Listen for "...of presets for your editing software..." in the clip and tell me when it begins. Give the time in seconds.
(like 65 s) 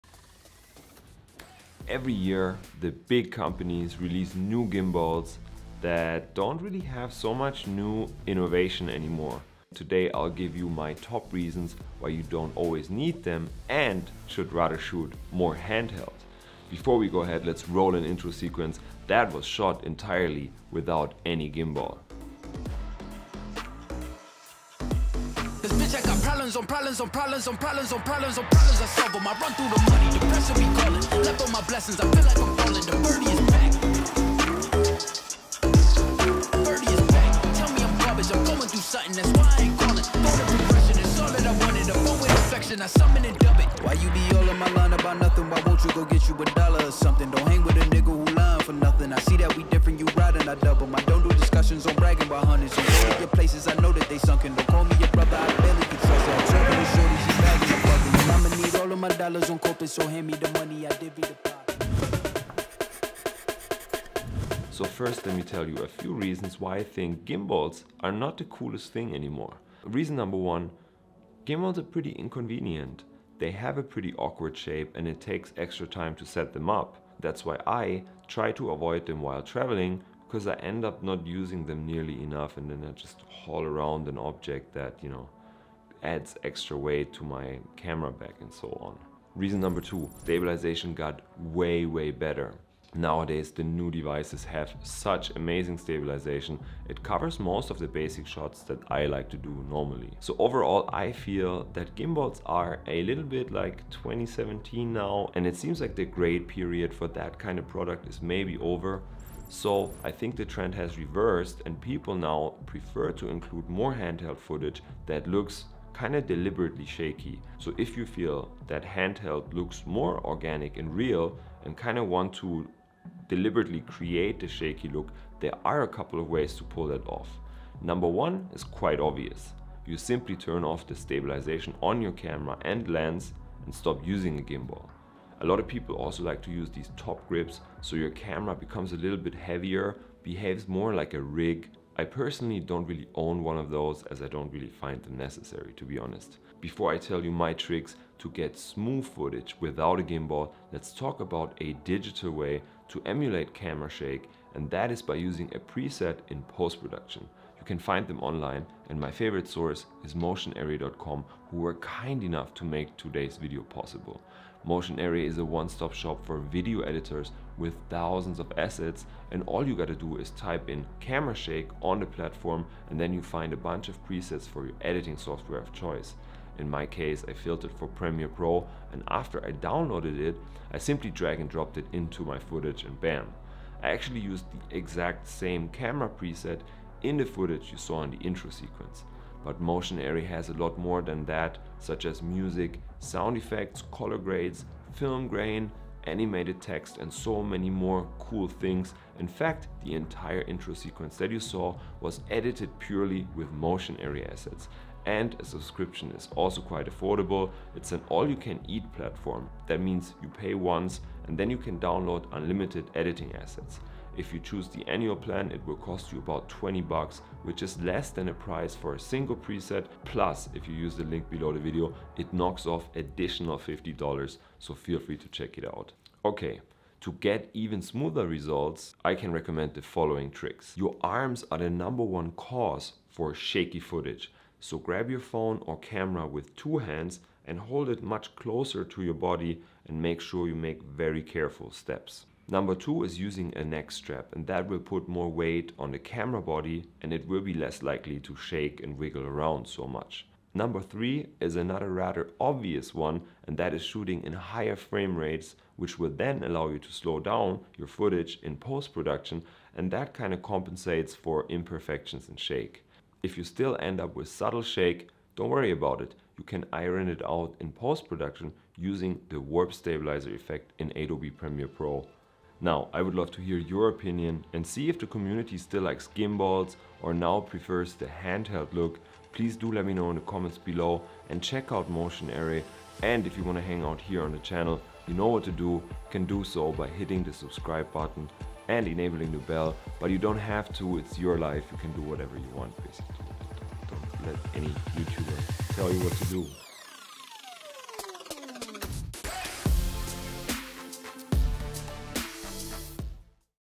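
173 s.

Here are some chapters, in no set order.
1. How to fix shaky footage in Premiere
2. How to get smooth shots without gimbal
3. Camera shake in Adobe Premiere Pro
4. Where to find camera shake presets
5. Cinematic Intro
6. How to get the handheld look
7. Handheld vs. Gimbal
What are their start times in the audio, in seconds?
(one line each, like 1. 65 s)
1. 260 s
2. 227 s
3. 150 s
4. 191 s
5. 22 s
6. 110 s
7. 66 s.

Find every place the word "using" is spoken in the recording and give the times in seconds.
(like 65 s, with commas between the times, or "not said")
81 s, 134 s, 155 s, 243 s, 268 s.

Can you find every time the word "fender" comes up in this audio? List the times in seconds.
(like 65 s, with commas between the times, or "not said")
not said.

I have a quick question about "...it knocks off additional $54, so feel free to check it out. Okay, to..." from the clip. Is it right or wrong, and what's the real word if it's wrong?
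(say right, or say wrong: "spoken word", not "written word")
wrong: "50", not "54".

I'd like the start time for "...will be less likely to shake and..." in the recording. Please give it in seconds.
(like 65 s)
247 s.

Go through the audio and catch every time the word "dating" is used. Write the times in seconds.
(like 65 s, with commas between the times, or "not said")
not said.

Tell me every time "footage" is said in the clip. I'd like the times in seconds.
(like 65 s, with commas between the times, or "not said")
114 s, 149 s, 182 s, 187 s, 233 s, 257 s.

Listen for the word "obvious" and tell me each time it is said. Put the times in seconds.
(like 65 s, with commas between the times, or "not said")
128 s, 252 s.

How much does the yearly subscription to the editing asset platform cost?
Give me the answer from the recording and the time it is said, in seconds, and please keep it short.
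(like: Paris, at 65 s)
$20, at 216 s.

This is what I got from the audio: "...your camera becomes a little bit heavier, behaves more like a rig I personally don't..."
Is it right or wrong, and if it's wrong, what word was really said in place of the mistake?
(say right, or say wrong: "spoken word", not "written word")
right.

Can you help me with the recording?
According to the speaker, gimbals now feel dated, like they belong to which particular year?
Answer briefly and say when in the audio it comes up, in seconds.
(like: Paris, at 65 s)
2017, at 103 s.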